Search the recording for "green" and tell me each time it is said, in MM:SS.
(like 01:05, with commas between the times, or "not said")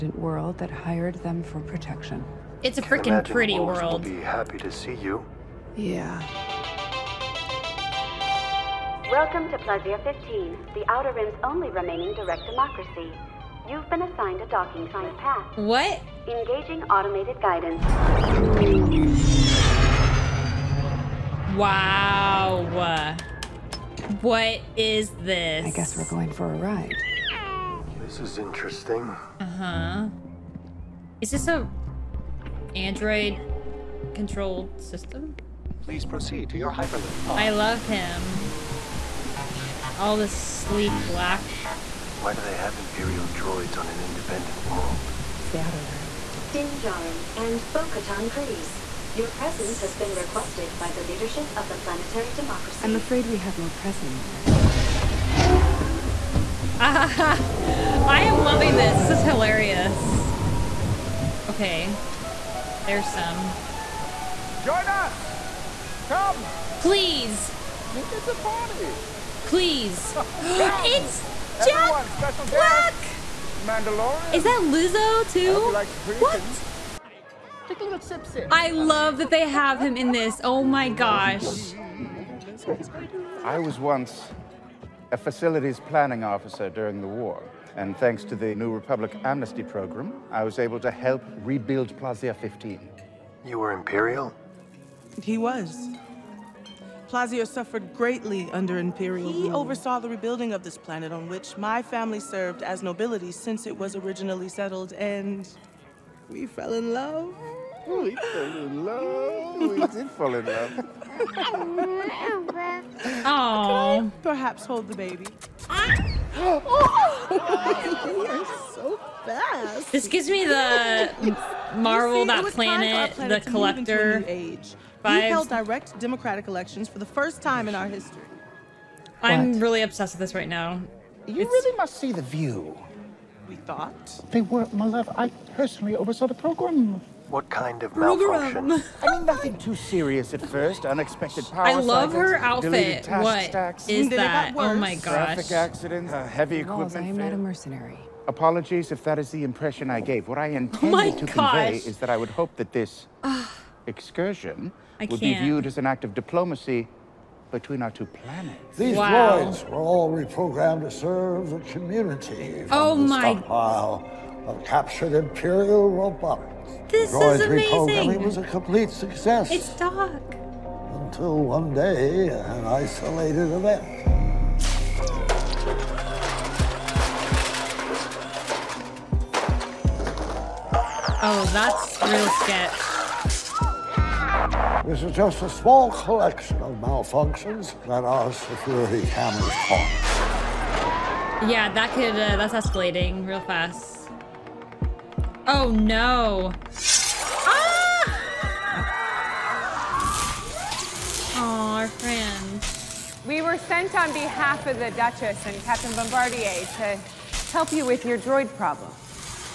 not said.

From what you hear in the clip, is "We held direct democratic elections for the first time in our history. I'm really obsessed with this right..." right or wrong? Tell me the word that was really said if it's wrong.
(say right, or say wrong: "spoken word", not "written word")
right.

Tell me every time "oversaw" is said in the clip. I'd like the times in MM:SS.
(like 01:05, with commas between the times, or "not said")
01:39, 02:15.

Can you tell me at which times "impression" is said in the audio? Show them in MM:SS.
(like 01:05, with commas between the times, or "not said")
02:29.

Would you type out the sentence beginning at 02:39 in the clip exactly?
droids were all reprogrammed to serve the community.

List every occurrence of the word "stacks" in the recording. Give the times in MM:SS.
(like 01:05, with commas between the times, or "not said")
02:23.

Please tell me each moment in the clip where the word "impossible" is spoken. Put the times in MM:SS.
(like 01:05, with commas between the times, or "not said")
not said.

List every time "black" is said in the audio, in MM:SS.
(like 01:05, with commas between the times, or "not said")
00:41, 01:12.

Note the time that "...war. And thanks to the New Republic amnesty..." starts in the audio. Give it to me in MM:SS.
01:27.